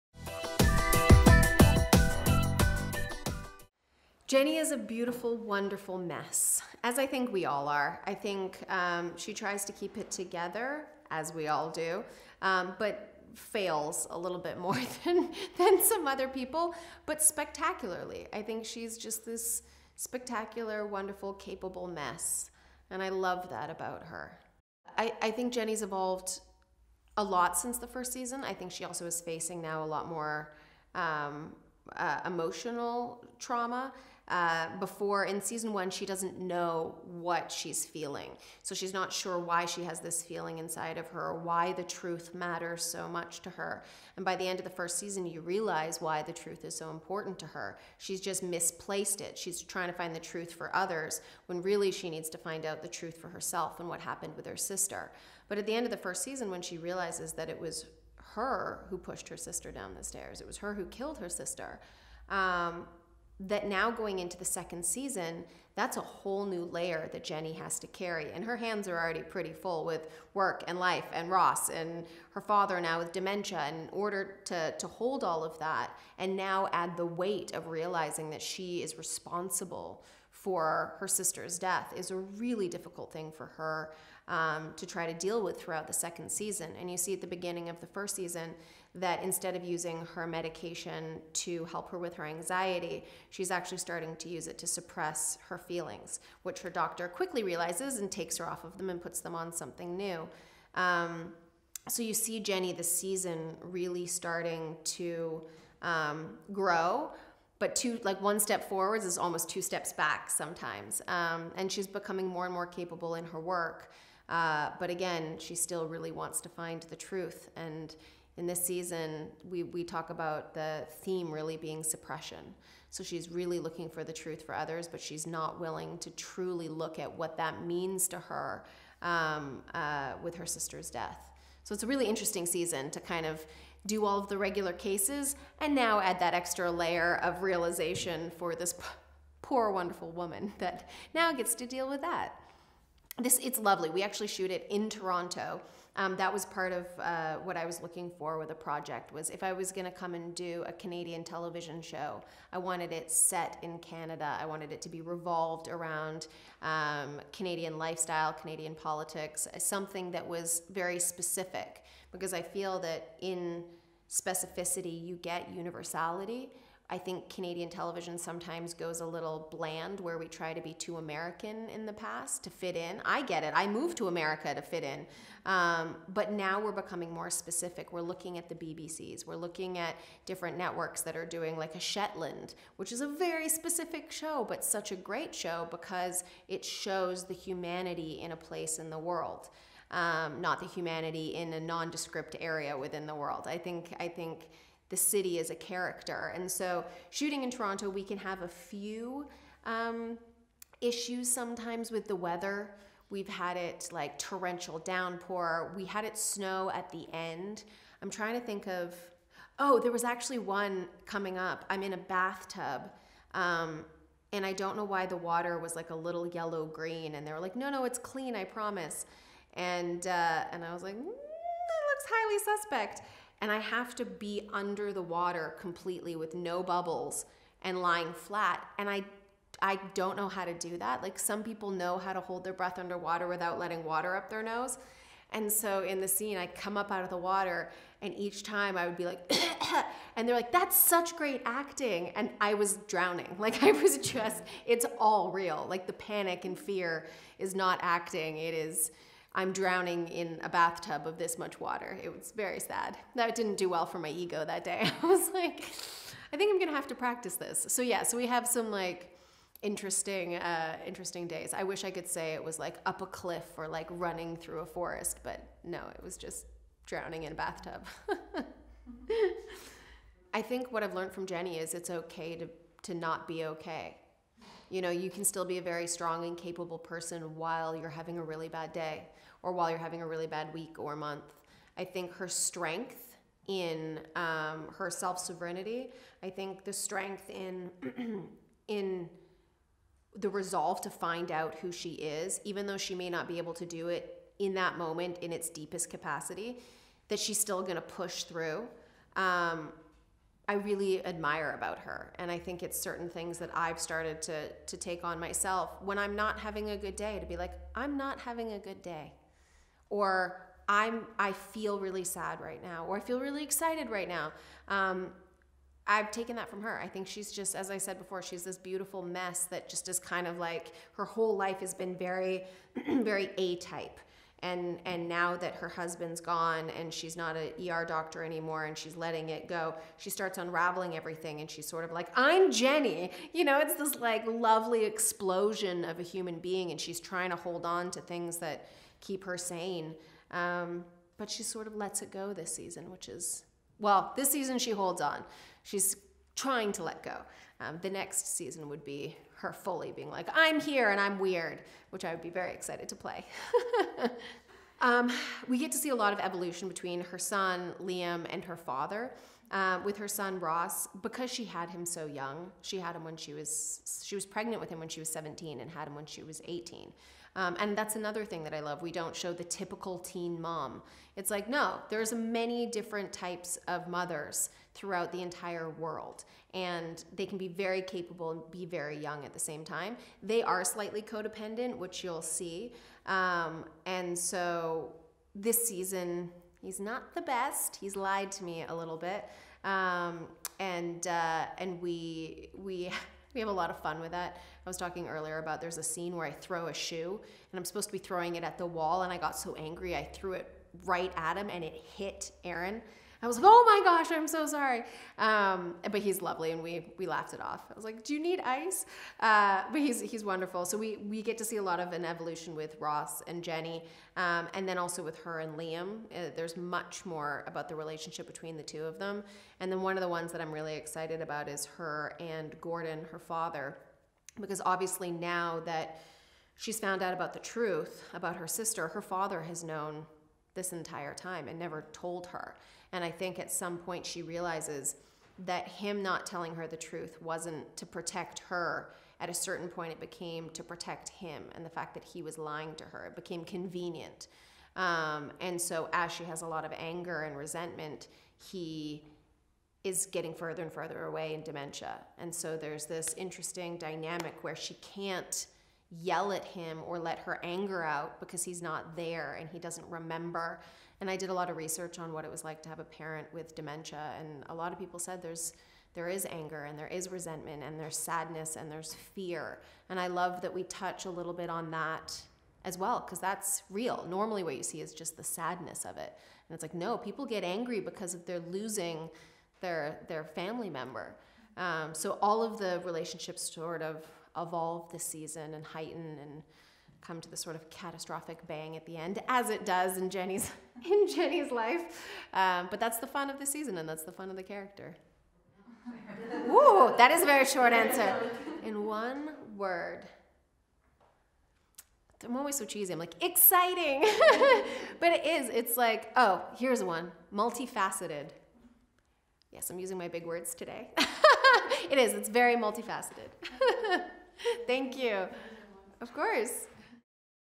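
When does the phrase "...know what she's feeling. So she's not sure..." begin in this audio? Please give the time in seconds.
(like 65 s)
36 s.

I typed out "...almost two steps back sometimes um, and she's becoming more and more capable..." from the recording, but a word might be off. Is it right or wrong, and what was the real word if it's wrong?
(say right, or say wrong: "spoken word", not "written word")
right.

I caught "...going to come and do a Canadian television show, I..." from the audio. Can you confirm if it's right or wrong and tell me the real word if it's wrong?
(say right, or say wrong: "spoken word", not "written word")
right.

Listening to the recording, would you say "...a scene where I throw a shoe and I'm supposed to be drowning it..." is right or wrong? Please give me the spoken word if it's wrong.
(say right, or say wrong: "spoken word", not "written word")
wrong: "throwing", not "drowning".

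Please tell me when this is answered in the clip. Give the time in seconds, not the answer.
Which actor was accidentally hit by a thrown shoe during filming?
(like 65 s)
402 s.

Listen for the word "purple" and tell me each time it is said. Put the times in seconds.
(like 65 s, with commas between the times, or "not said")
not said.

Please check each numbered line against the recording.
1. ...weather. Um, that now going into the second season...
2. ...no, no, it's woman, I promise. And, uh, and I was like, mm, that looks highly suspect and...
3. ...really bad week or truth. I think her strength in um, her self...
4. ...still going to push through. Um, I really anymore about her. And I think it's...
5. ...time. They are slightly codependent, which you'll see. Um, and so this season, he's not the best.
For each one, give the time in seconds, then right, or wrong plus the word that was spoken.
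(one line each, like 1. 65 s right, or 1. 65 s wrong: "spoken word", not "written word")
1. 61 s wrong: "sister", not "weather"
2. 217 s wrong: "clean", not "woman"
3. 280 s wrong: "month", not "truth"
4. 297 s wrong: "admire", not "anymore"
5. 379 s right.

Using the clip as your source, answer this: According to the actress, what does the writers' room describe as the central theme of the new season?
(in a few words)
suppression.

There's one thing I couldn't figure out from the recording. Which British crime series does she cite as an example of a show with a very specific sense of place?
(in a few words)
Shetland.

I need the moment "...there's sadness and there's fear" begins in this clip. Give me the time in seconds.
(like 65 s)
467 s.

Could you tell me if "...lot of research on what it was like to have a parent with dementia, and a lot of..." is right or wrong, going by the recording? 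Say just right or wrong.
right.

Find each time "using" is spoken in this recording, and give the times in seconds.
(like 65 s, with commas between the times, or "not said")
89 s, 509 s.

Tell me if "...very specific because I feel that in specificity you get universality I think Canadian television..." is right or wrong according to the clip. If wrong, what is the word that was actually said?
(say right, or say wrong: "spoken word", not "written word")
right.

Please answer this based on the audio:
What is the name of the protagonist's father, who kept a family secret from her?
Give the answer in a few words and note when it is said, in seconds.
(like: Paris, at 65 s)
Gordon, at 422 s.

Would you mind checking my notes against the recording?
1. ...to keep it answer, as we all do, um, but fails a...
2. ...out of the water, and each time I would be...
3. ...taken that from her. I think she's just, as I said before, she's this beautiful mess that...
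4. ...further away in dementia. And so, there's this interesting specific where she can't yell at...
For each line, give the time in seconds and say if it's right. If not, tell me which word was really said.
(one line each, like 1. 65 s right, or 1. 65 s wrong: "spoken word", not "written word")
1. 9 s wrong: "together", not "answer"
2. 236 s right
3. 316 s right
4. 450 s wrong: "dynamic", not "specific".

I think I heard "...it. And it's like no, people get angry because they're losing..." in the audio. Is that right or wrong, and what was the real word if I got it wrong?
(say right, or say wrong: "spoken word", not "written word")
right.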